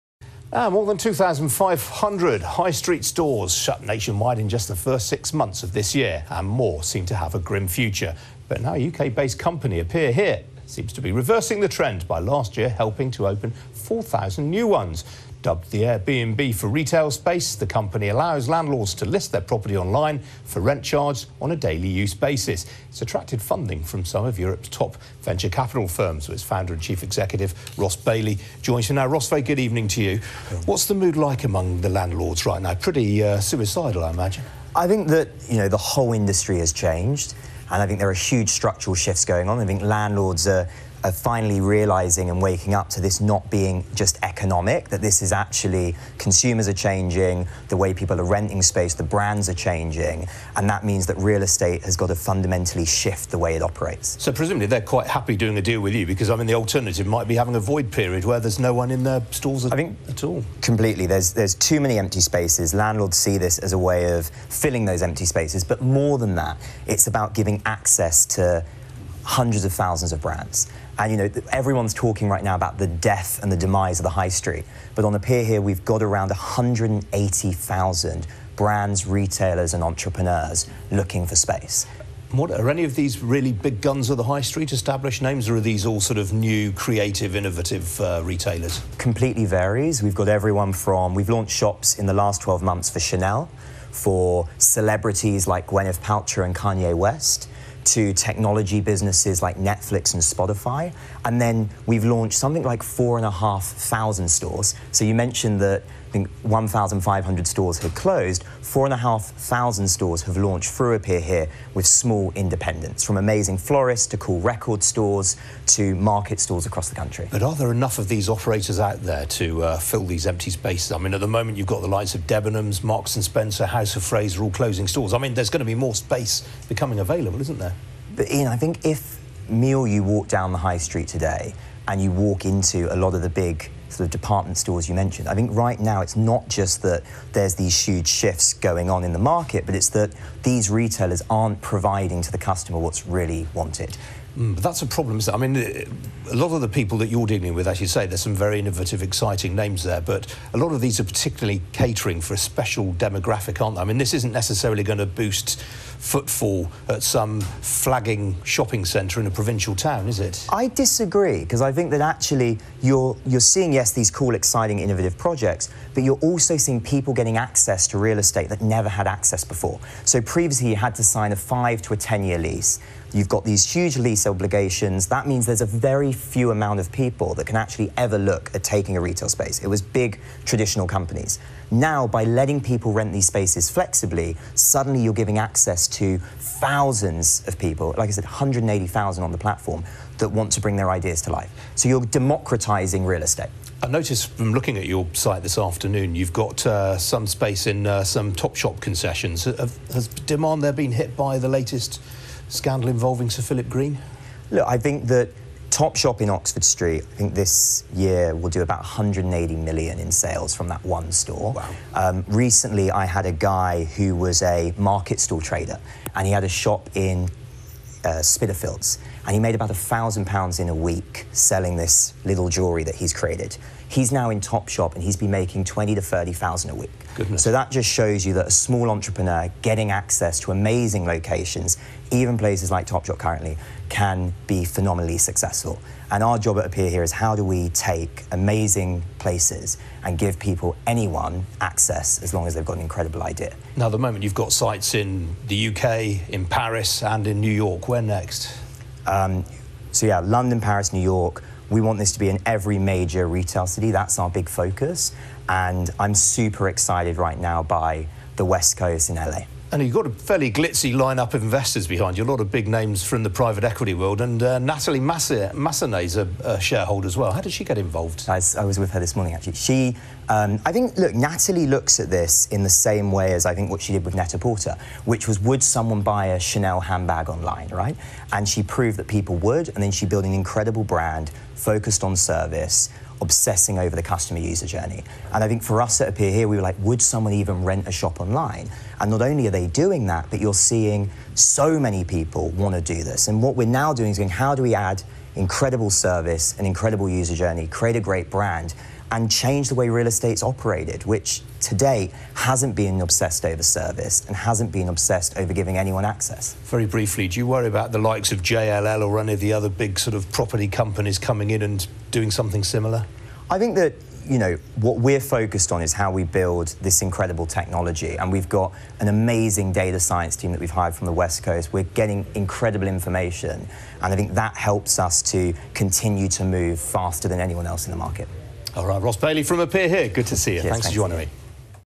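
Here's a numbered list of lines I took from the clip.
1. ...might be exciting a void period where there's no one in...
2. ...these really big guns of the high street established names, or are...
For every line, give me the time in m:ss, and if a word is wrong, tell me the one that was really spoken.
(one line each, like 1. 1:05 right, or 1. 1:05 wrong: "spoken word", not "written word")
1. 0:57 wrong: "having", not "exciting"
2. 1:22 right.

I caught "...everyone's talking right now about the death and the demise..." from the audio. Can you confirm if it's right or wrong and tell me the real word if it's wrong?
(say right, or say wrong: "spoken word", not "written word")
right.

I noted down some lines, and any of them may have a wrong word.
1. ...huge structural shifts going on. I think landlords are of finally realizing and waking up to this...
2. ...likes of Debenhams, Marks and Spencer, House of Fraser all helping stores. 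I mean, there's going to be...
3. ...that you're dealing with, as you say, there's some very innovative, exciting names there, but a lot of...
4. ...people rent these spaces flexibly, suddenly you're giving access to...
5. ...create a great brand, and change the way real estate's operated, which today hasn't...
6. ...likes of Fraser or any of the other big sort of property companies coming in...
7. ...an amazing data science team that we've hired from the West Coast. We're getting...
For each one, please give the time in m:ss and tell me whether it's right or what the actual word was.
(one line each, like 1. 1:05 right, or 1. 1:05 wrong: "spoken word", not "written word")
1. 0:38 right
2. 2:01 wrong: "closing", not "helping"
3. 2:26 right
4. 3:02 right
5. 4:57 right
6. 5:07 wrong: "JLL", not "Fraser"
7. 5:18 right.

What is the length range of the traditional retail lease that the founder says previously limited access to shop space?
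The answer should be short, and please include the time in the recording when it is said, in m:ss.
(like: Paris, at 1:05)
5 to 10 years, at 2:51.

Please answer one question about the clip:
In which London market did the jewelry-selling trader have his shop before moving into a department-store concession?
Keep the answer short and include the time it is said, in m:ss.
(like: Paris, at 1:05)
Spitalfields, at 3:38.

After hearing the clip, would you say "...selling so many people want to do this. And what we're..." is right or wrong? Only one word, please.
wrong.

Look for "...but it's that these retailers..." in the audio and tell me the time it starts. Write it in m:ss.
2:19.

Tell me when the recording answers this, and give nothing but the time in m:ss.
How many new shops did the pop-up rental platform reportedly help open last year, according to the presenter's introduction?
0:13.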